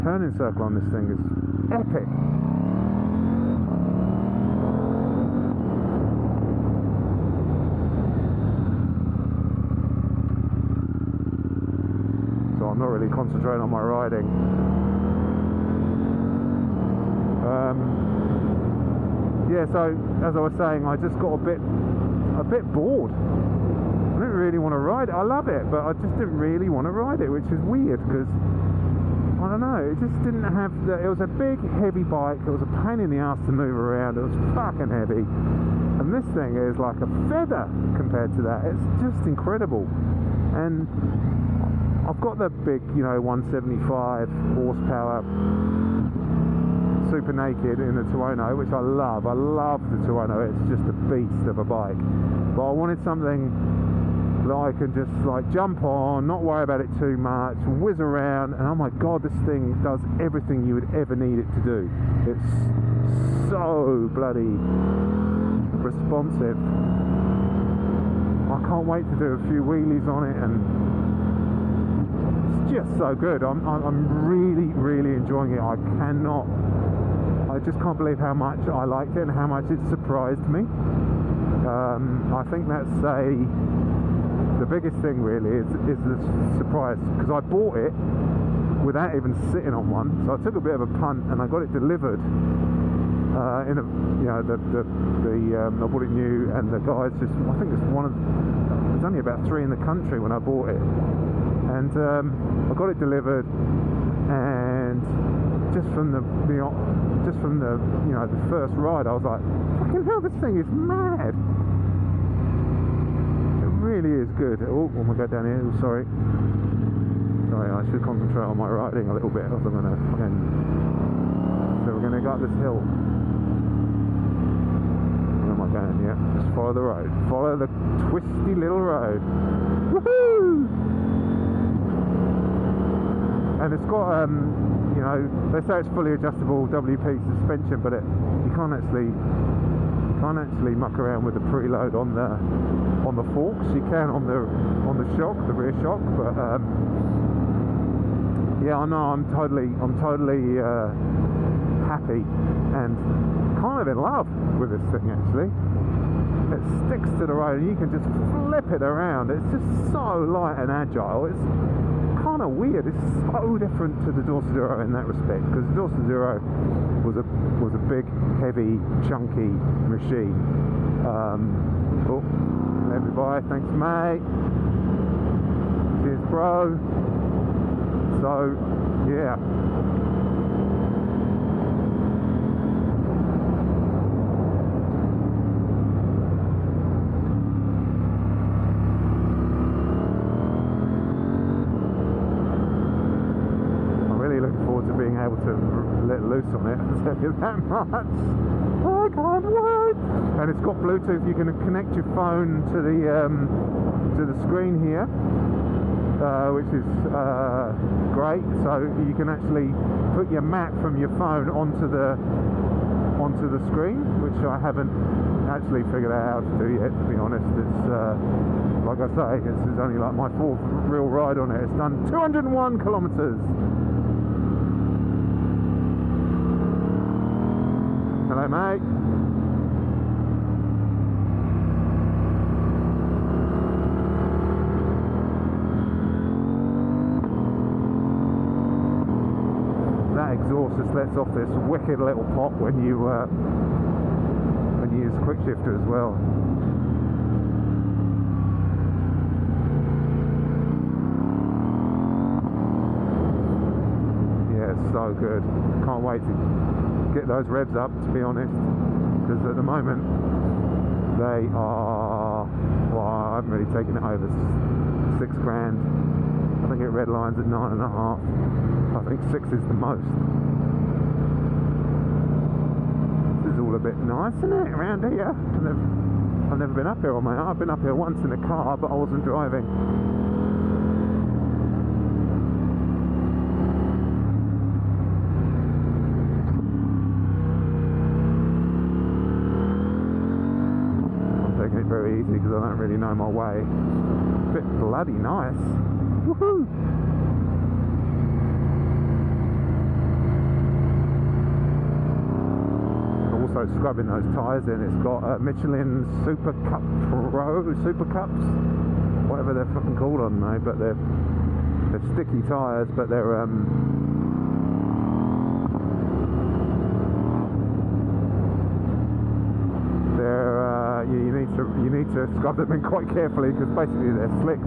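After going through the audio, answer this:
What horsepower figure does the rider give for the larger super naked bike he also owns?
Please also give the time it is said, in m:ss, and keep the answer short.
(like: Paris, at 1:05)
175, at 0:43.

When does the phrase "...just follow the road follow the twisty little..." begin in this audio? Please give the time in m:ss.
2:06.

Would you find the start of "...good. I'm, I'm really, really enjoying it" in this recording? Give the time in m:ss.
1:13.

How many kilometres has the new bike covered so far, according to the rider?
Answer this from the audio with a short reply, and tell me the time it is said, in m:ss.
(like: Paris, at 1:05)
201, at 3:42.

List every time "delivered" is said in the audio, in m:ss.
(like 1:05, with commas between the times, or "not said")
1:31, 1:43.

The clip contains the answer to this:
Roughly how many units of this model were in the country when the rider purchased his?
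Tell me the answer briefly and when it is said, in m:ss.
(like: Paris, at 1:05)
3, at 1:39.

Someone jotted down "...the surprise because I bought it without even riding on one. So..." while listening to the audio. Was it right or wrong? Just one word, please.
wrong.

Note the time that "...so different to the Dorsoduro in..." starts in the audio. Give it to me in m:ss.
2:43.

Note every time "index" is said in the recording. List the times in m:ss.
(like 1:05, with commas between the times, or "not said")
not said.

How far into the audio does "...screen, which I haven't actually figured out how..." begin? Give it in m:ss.
3:33.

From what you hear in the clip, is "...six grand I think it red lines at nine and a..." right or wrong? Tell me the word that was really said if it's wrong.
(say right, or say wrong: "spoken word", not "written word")
right.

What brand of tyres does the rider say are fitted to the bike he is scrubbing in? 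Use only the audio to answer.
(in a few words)
Michelin.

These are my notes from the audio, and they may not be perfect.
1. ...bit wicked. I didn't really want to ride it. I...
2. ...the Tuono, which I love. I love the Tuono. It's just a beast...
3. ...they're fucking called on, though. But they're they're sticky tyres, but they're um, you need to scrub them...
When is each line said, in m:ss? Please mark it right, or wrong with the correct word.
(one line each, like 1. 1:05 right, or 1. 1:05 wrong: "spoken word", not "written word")
1. 0:22 wrong: "bored", not "wicked"
2. 0:47 right
3. 5:09 right.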